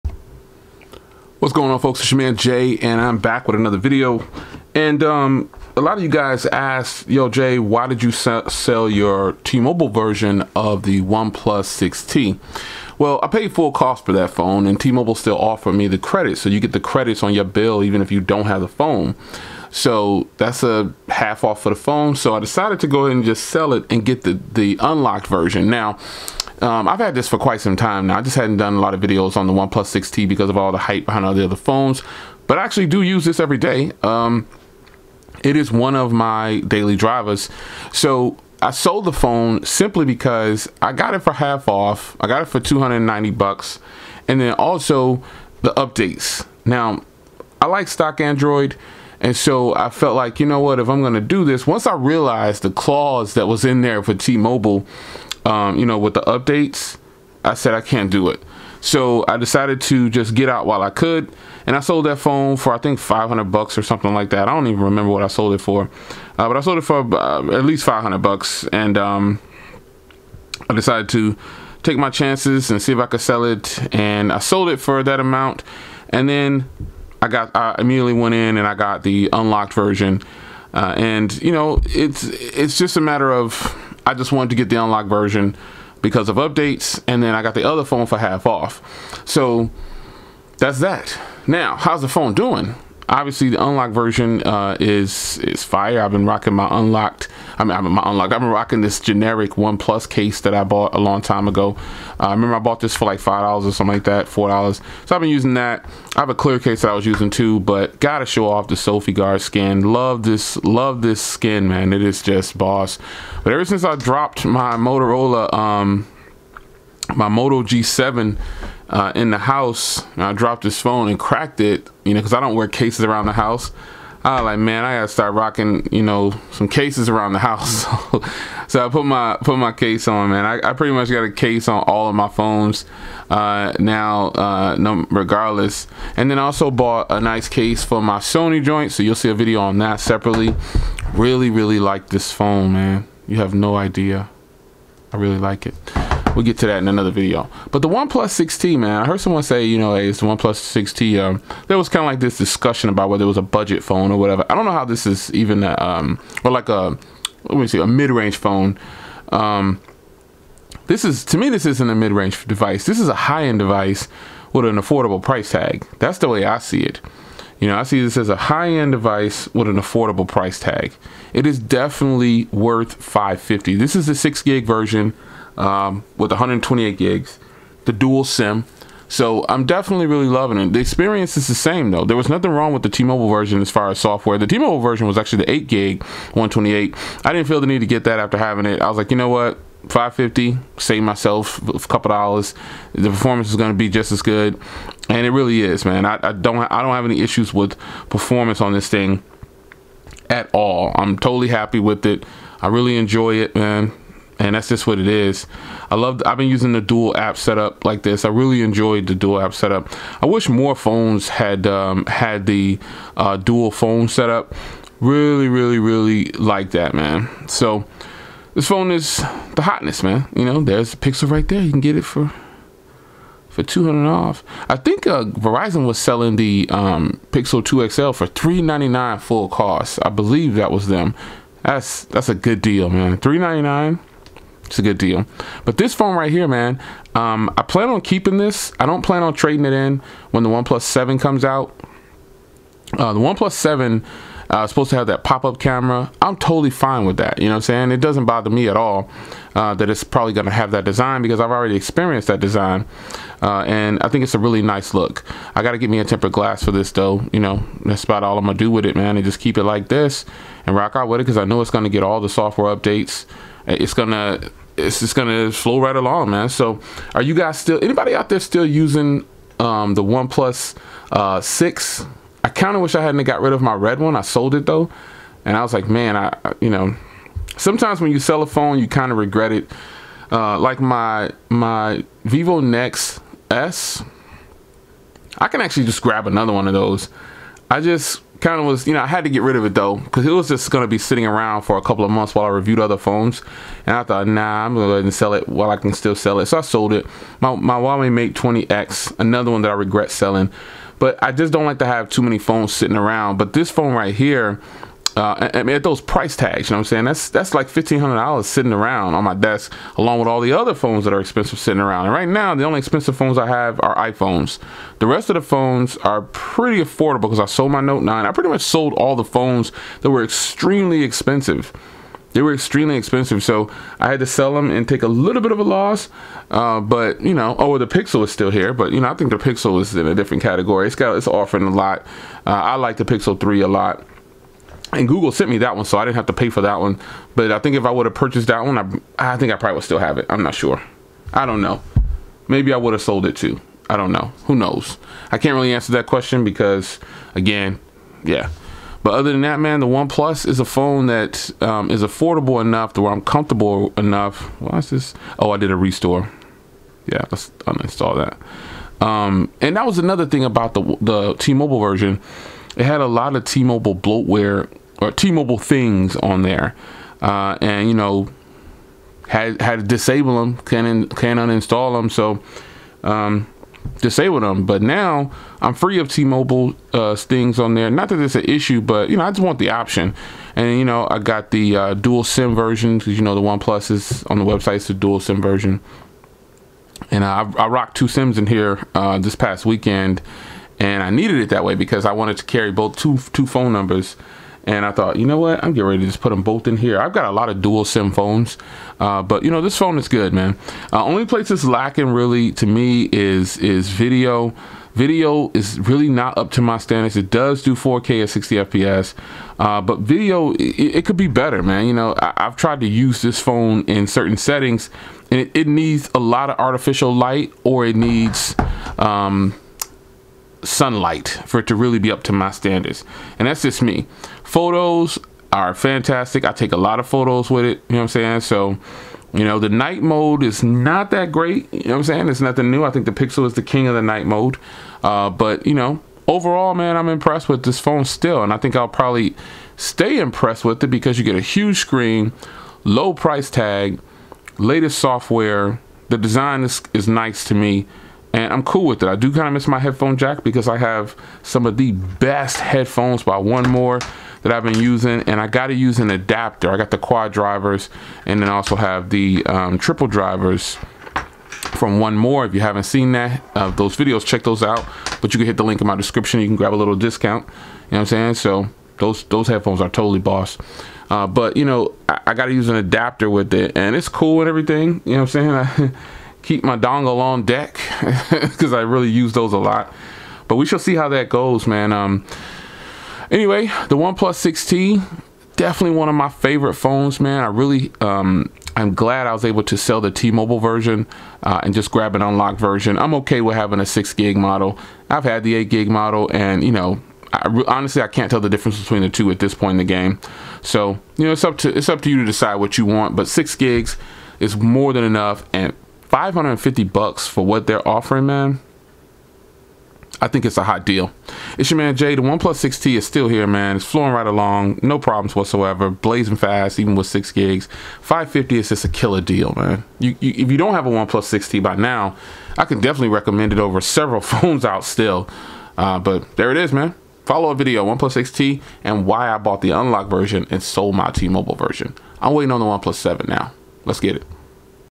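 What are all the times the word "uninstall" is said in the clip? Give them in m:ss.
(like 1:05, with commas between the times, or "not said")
5:57, 6:11.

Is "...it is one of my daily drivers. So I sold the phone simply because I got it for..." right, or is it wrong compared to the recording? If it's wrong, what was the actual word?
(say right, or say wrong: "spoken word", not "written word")
right.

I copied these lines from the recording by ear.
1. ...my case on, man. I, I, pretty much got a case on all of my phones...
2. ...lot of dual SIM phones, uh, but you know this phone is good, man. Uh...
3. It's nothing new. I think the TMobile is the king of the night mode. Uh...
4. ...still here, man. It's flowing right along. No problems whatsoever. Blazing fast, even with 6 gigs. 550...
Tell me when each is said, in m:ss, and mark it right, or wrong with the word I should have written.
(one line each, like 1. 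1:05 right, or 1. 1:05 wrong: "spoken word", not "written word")
1. 2:09 right
2. 6:37 right
3. 7:12 wrong: "Pixel", not "TMobile"
4. 8:33 right.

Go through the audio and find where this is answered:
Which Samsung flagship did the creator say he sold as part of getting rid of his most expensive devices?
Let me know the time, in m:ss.
5:17.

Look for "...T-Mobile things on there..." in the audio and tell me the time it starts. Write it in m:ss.
6:05.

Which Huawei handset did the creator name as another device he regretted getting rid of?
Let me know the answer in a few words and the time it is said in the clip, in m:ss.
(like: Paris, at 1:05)
Huawei Mate 20X, at 4:57.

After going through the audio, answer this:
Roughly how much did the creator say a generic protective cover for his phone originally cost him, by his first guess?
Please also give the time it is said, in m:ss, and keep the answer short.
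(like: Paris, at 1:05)
$5, at 1:43.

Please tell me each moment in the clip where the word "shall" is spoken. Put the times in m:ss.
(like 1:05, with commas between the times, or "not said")
8:00.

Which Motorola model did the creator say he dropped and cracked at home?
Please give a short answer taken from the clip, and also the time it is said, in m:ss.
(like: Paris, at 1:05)
Moto G7, at 1:57.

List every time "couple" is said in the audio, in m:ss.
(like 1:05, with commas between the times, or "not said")
3:11, 4:51.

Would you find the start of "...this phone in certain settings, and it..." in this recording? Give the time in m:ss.
6:53.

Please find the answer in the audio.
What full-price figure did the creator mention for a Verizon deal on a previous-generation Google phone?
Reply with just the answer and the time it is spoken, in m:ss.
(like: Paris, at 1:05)
$399, at 3:48.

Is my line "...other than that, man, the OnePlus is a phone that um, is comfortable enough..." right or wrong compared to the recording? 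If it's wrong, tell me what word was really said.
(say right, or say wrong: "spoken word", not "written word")
wrong: "affordable", not "comfortable".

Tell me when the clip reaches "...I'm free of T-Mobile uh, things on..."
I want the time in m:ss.
6:15.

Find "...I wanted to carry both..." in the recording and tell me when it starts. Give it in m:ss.
6:32.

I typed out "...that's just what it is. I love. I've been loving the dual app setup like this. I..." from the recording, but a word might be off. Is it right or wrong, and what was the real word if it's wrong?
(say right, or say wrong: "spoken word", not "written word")
wrong: "using", not "loving".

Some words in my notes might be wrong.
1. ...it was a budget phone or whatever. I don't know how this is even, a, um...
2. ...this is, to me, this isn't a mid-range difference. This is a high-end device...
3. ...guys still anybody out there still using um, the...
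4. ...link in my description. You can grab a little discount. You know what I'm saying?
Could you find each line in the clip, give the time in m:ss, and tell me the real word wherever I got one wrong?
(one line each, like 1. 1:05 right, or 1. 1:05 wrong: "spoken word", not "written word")
1. 2:33 right
2. 2:40 wrong: "device", not "difference"
3. 4:27 right
4. 7:45 right.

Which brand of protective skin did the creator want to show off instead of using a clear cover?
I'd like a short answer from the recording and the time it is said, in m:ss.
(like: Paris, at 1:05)
Sophie Guard, at 1:48.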